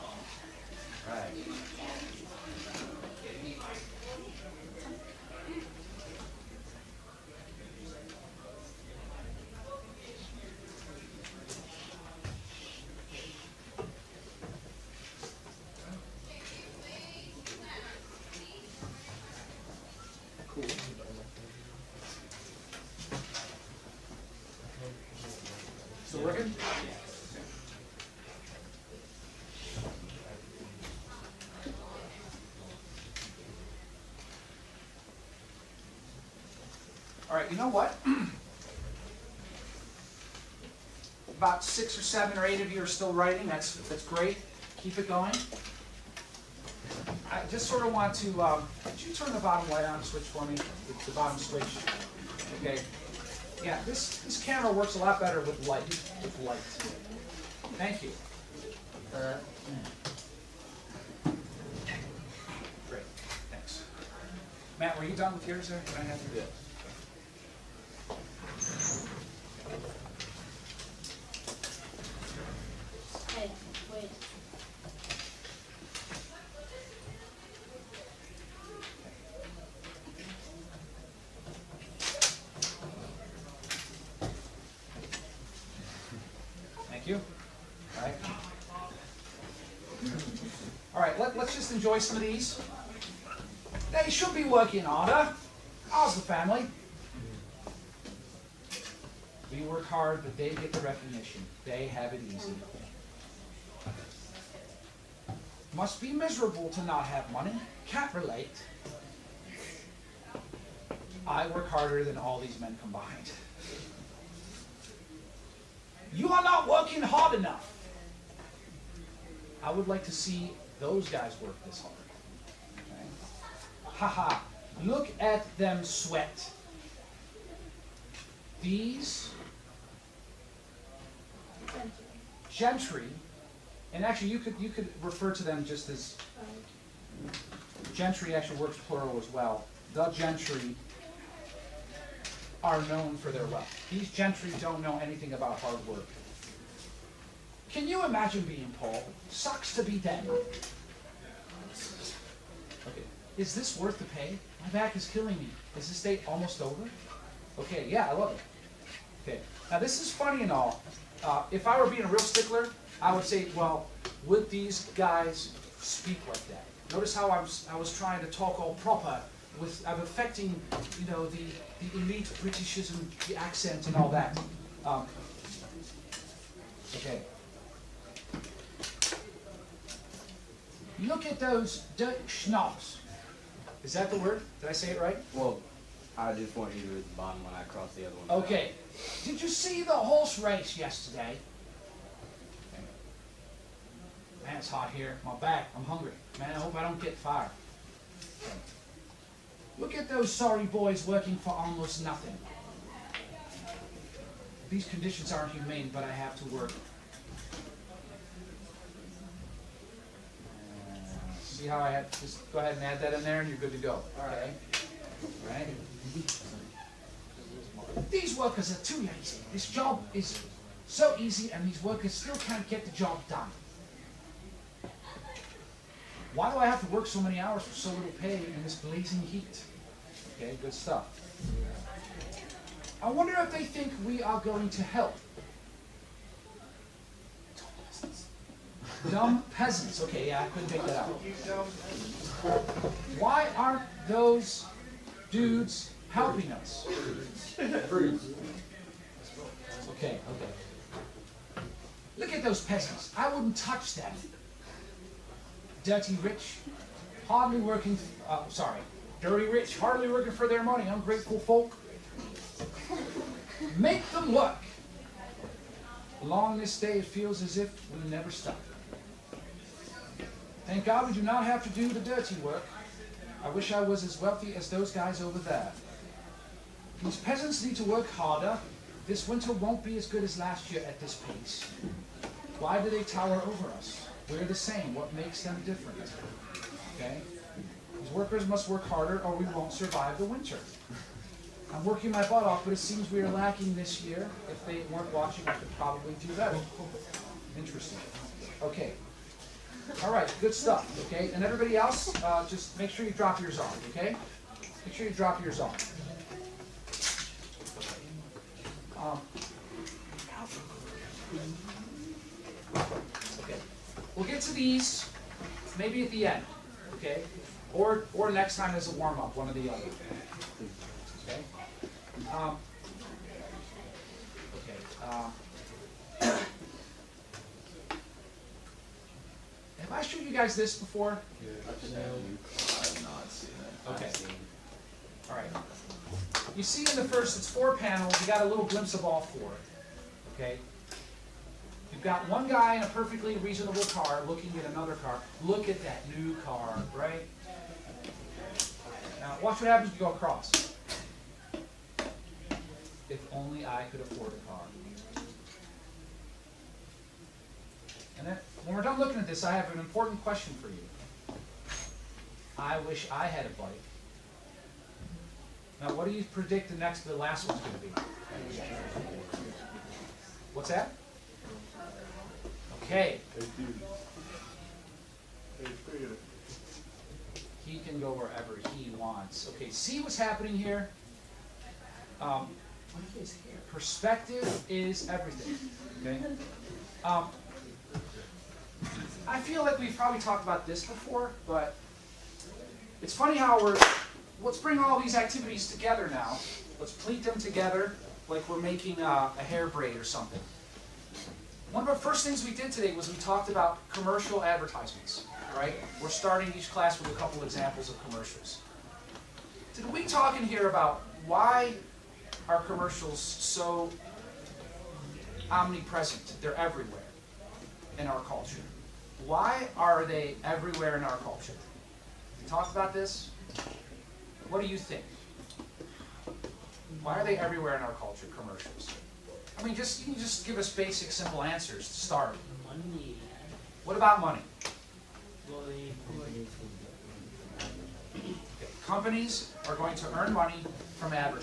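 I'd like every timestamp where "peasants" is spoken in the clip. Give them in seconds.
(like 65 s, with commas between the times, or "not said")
239 s, 252 s, 277 s.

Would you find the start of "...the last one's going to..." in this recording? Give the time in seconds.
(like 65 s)
367 s.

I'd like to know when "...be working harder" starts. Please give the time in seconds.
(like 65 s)
94 s.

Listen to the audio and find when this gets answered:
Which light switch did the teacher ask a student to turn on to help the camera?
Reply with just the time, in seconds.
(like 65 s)
51 s.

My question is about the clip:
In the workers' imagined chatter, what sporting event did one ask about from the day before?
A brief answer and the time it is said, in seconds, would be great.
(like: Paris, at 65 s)
Horse race, at 189 s.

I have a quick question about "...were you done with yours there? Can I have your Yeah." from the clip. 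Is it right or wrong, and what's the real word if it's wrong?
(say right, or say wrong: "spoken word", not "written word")
right.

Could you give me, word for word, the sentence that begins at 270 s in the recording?
Thank God we do not have to do the dirty work.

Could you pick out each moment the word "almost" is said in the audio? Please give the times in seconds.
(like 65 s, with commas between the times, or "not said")
156 s, 201 s.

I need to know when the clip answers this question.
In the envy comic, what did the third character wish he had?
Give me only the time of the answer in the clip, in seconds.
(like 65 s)
363 s.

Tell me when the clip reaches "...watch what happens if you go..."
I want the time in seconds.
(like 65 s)
349 s.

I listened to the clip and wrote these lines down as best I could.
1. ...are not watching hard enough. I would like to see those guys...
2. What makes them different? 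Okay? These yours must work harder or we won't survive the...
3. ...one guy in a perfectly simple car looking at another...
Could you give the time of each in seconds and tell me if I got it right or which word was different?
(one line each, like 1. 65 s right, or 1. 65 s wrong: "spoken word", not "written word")
1. 116 s wrong: "working", not "watching"
2. 284 s wrong: "workers", not "yours"
3. 342 s wrong: "reasonable", not "simple".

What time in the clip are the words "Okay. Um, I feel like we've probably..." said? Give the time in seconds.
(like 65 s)
386 s.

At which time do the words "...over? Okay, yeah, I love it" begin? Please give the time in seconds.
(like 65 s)
156 s.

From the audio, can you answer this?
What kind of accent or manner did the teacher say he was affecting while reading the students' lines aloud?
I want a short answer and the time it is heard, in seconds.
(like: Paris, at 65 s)
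Elite Britishism, at 171 s.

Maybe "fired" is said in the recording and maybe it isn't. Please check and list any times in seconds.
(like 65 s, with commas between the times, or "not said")
197 s.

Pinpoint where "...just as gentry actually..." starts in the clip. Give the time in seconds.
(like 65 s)
135 s.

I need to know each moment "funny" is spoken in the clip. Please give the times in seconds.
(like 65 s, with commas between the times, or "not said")
160 s, 393 s.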